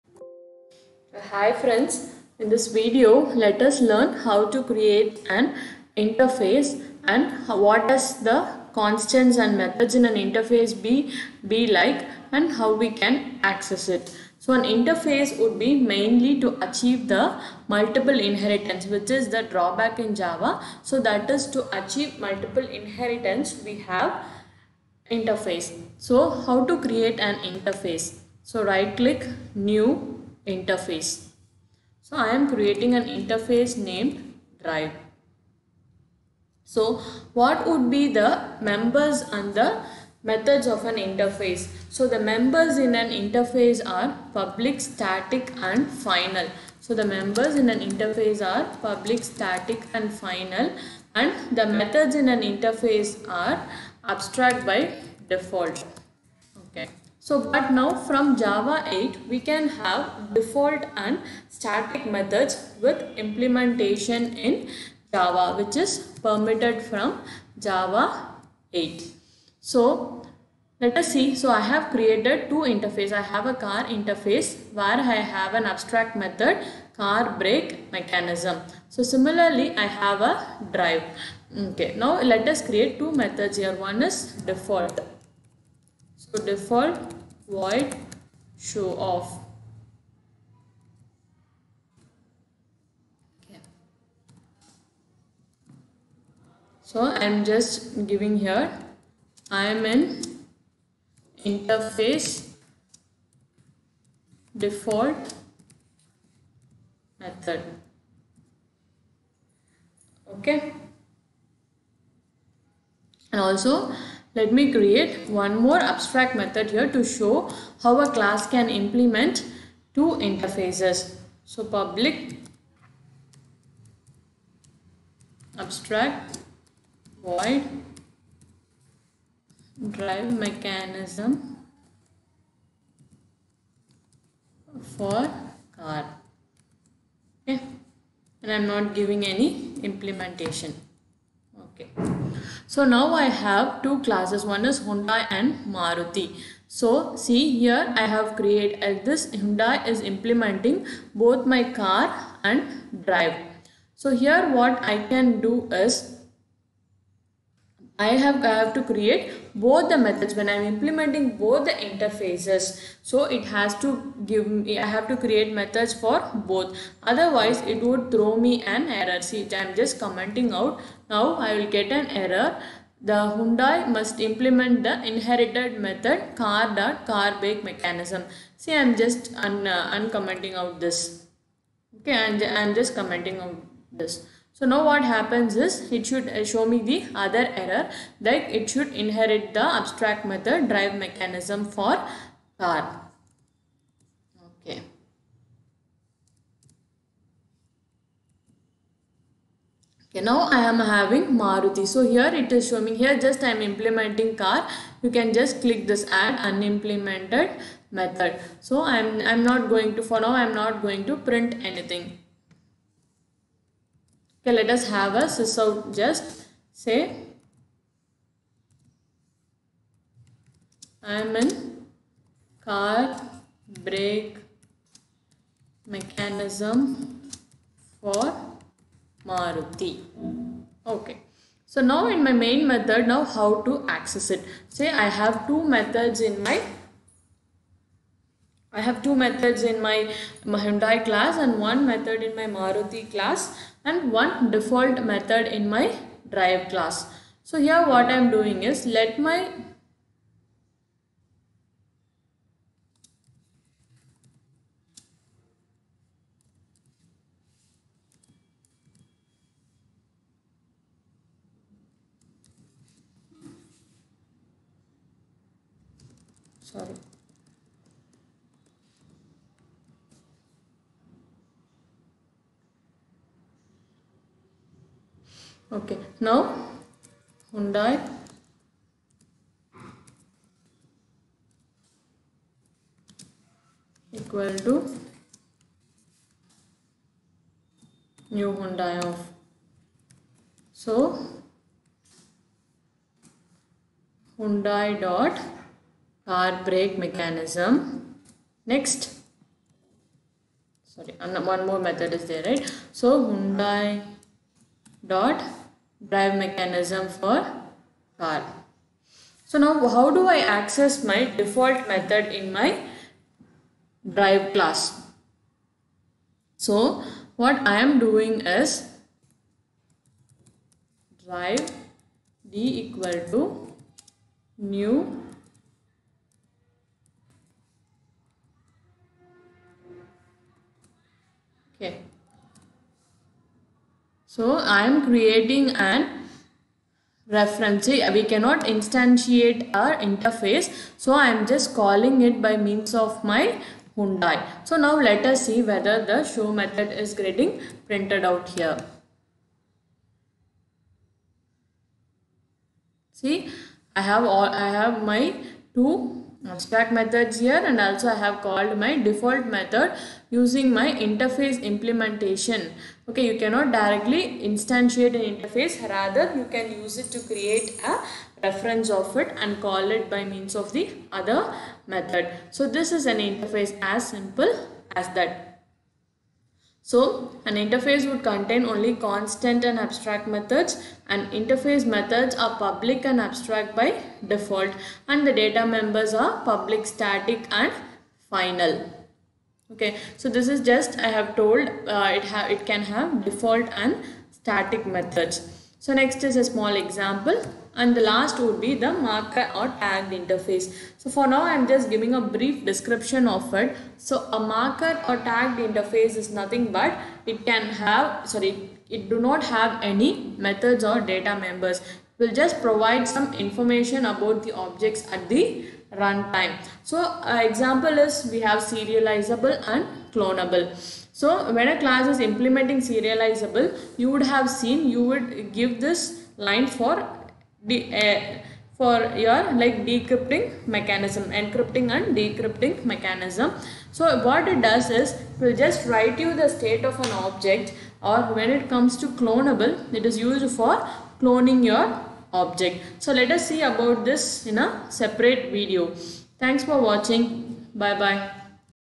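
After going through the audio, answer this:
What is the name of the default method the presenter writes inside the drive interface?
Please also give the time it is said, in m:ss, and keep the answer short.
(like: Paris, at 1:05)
show off, at 1:28.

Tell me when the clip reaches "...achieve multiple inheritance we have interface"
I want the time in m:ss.
0:21.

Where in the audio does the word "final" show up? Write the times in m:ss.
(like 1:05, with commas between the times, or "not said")
0:45, 0:50, 6:28.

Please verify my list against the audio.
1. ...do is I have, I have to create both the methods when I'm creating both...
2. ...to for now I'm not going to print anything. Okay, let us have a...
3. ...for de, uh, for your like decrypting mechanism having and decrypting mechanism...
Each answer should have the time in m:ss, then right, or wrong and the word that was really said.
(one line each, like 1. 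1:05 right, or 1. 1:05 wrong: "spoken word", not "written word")
1. 2:35 wrong: "implementing", not "creating"
2. 3:29 right
3. 7:06 wrong: "encrypting", not "having".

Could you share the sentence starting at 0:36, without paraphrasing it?
So what would be the members and the methods of an interface.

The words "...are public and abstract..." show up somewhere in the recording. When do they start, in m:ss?
6:22.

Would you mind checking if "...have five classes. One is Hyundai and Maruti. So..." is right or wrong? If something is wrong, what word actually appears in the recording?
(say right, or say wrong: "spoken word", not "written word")
wrong: "two", not "five".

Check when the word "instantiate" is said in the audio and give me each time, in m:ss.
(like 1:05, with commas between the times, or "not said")
5:38, 6:04.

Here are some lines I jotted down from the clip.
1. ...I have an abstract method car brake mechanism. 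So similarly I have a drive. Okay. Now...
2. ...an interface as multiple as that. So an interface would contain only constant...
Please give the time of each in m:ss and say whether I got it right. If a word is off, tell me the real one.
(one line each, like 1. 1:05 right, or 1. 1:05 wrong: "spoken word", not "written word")
1. 1:15 right
2. 6:13 wrong: "simple", not "multiple".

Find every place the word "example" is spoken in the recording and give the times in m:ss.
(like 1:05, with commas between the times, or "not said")
6:36, 6:57.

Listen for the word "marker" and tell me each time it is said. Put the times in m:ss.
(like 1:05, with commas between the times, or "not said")
6:38, 6:44.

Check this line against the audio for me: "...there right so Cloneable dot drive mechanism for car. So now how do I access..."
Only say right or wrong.
wrong.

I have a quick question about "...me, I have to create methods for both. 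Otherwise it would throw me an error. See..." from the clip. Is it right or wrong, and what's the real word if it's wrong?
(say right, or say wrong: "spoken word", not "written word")
right.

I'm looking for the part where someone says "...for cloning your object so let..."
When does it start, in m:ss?
7:20.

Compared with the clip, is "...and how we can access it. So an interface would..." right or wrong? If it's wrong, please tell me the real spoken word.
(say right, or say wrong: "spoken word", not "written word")
right.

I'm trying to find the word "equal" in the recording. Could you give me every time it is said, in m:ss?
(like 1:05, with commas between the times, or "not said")
4:44, 5:22.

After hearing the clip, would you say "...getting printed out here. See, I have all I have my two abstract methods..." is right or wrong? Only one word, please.
right.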